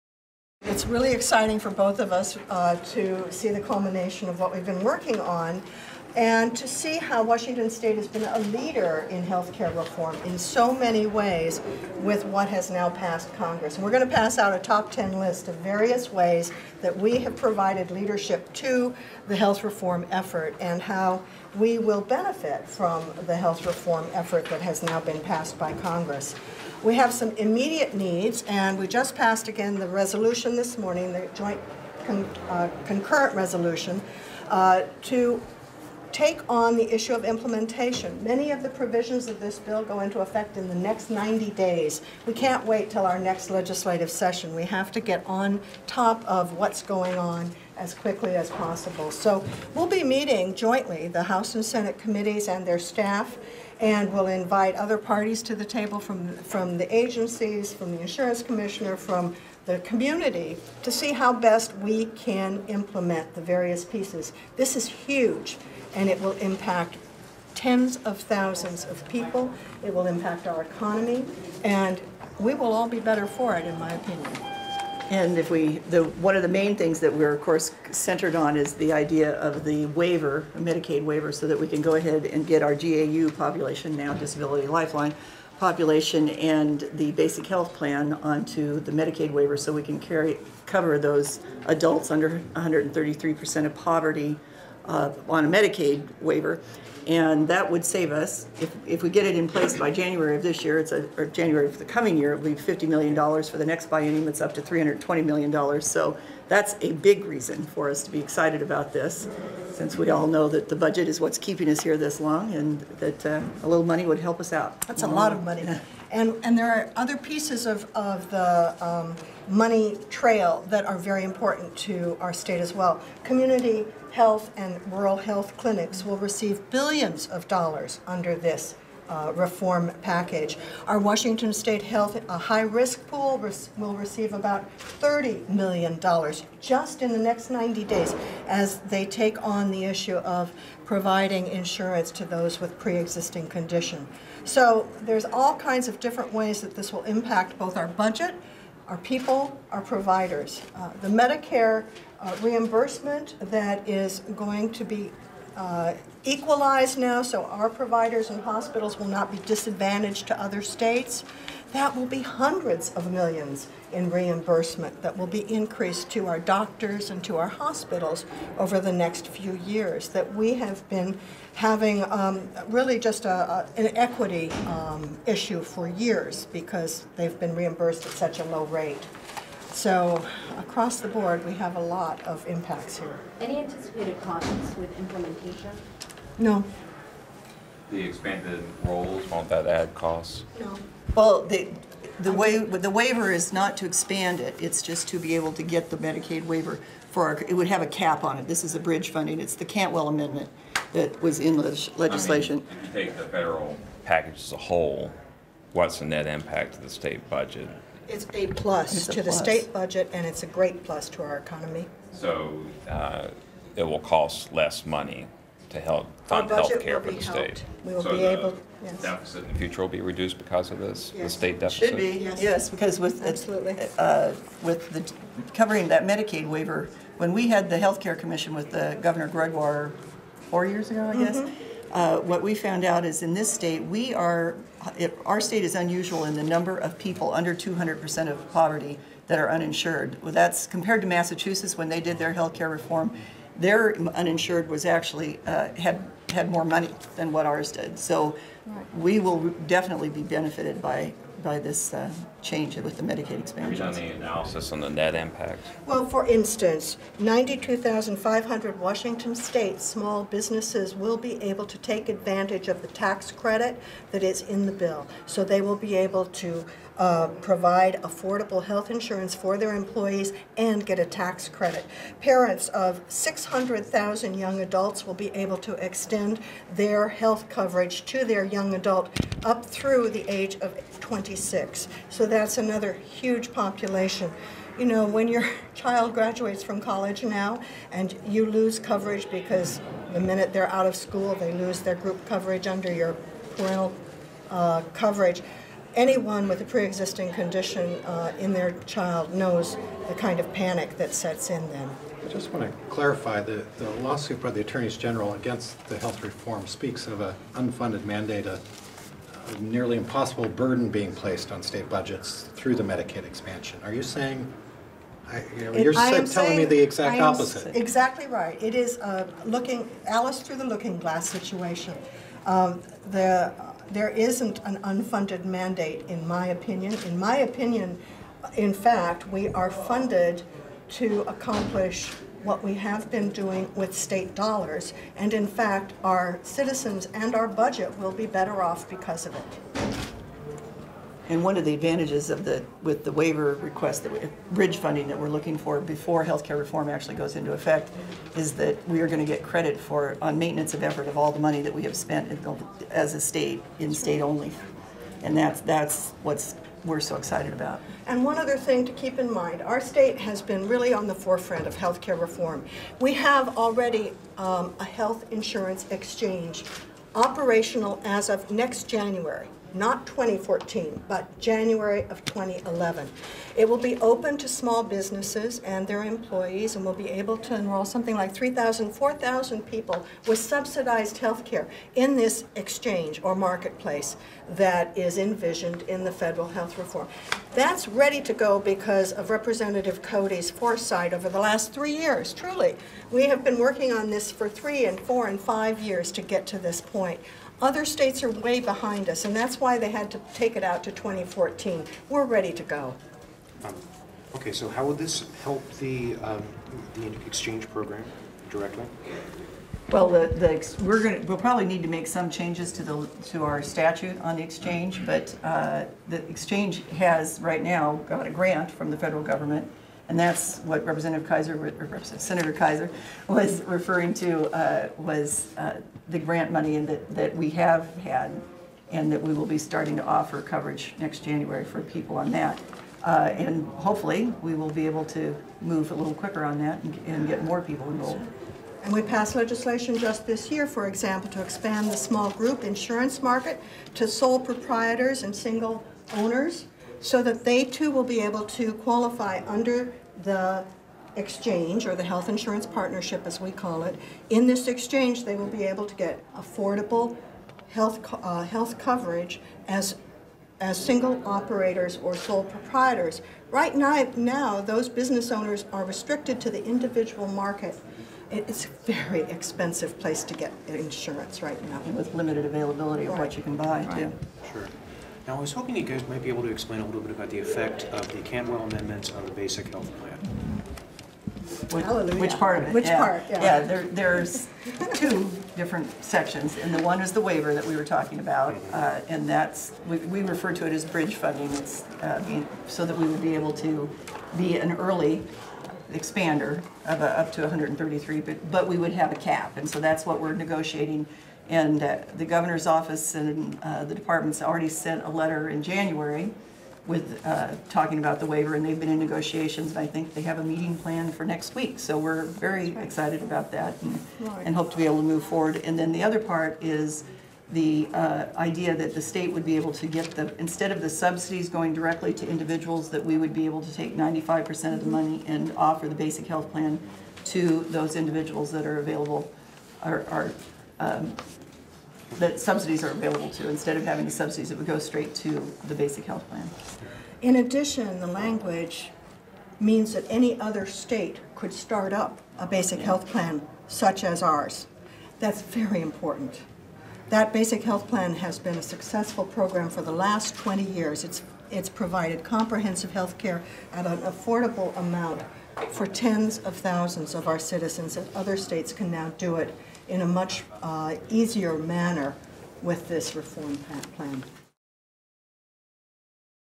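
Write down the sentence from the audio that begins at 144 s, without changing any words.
So there's all kinds of different ways that this will impact both our budget, our people, our providers.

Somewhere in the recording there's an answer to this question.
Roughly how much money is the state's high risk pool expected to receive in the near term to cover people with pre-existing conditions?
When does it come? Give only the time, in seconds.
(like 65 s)
134 s.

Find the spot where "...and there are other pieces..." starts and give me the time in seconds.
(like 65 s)
116 s.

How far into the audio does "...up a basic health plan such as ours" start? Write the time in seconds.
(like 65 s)
541 s.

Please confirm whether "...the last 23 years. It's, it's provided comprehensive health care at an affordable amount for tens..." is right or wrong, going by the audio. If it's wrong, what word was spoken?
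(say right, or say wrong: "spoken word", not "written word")
wrong: "20", not "23".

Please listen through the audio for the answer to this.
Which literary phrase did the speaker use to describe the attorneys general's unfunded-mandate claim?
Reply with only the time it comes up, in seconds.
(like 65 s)
320 s.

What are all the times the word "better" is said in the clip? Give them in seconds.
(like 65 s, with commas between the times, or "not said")
72 s, 338 s.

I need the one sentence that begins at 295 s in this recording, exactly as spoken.
Anyone with a pre-existing condition uh, in their child knows the kind of panic that sets in then.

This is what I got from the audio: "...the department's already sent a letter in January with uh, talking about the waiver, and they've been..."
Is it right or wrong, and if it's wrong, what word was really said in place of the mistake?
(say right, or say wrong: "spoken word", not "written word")
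right.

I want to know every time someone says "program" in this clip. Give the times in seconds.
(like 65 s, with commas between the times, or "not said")
407 s, 549 s.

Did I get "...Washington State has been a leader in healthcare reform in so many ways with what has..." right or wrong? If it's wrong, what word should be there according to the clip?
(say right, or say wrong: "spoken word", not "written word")
right.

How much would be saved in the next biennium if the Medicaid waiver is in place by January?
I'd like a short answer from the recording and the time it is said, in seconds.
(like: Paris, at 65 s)
$50 million, at 102 s.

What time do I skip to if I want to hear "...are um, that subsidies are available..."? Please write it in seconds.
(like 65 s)
530 s.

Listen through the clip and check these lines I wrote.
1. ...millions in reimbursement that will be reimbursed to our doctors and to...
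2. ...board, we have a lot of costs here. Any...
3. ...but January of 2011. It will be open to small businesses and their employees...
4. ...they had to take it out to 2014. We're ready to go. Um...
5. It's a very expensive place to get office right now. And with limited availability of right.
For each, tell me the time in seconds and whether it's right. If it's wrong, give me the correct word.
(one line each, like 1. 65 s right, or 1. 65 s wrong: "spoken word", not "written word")
1. 163 s wrong: "increased", not "reimbursed"
2. 181 s wrong: "impacts", not "costs"
3. 371 s right
4. 399 s right
5. 468 s wrong: "insurance", not "office".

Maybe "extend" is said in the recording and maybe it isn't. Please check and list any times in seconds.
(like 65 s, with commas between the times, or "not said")
275 s.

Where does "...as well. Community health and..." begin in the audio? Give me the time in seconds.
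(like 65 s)
122 s.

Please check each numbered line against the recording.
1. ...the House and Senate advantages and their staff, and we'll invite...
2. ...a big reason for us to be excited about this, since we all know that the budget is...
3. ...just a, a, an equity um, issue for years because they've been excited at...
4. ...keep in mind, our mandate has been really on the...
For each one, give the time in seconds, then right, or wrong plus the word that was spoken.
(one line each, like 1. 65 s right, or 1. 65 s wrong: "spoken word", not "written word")
1. 51 s wrong: "committees", not "advantages"
2. 106 s right
3. 172 s wrong: "reimbursed", not "excited"
4. 358 s wrong: "state", not "mandate".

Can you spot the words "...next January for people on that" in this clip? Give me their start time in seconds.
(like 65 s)
430 s.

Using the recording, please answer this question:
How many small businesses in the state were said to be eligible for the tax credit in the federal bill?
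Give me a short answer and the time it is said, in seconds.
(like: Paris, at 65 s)
92,500, at 257 s.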